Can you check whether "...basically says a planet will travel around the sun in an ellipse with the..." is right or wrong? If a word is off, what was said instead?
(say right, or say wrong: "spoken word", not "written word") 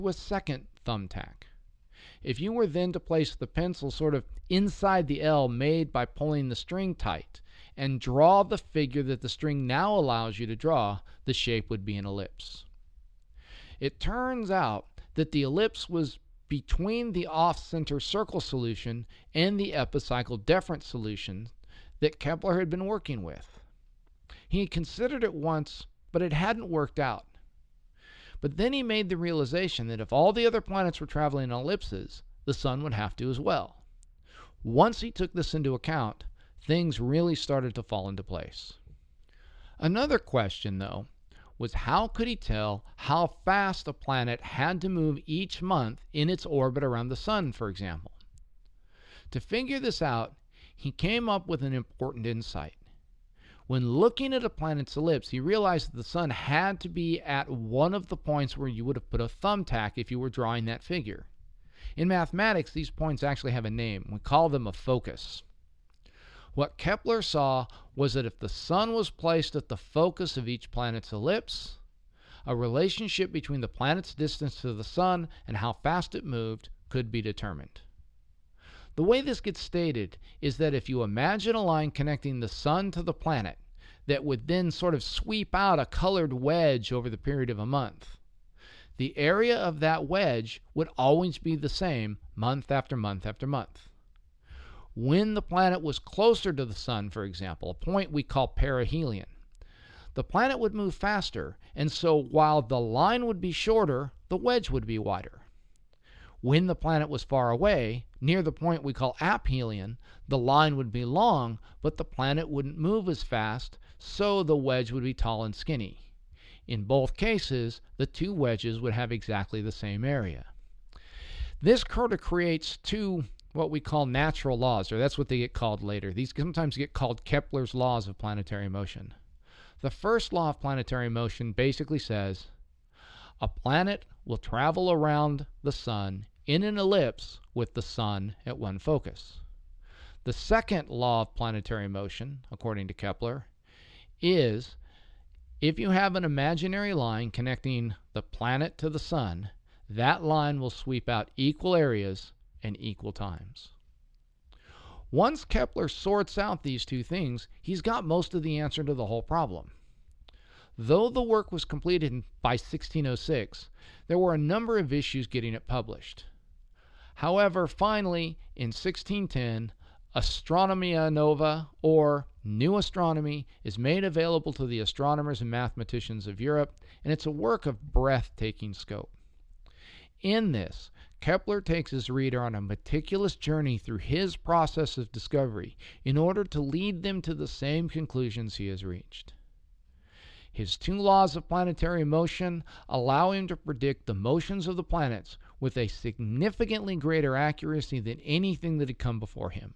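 right.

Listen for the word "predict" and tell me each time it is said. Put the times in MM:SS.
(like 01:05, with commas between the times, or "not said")
03:13.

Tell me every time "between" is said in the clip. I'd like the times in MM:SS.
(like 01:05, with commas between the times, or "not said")
00:16, 01:13.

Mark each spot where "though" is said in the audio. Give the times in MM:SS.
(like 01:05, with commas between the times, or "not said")
00:40, 02:40.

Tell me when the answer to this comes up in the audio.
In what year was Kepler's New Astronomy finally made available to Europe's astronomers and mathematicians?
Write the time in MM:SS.
02:48.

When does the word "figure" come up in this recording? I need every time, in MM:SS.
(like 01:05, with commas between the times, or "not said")
00:08, 00:49, 01:00.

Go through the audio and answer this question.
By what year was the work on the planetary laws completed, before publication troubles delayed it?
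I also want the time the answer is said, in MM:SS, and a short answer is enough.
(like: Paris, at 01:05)
1606, at 02:42.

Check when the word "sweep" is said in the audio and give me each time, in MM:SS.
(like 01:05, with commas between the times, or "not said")
01:25, 02:30.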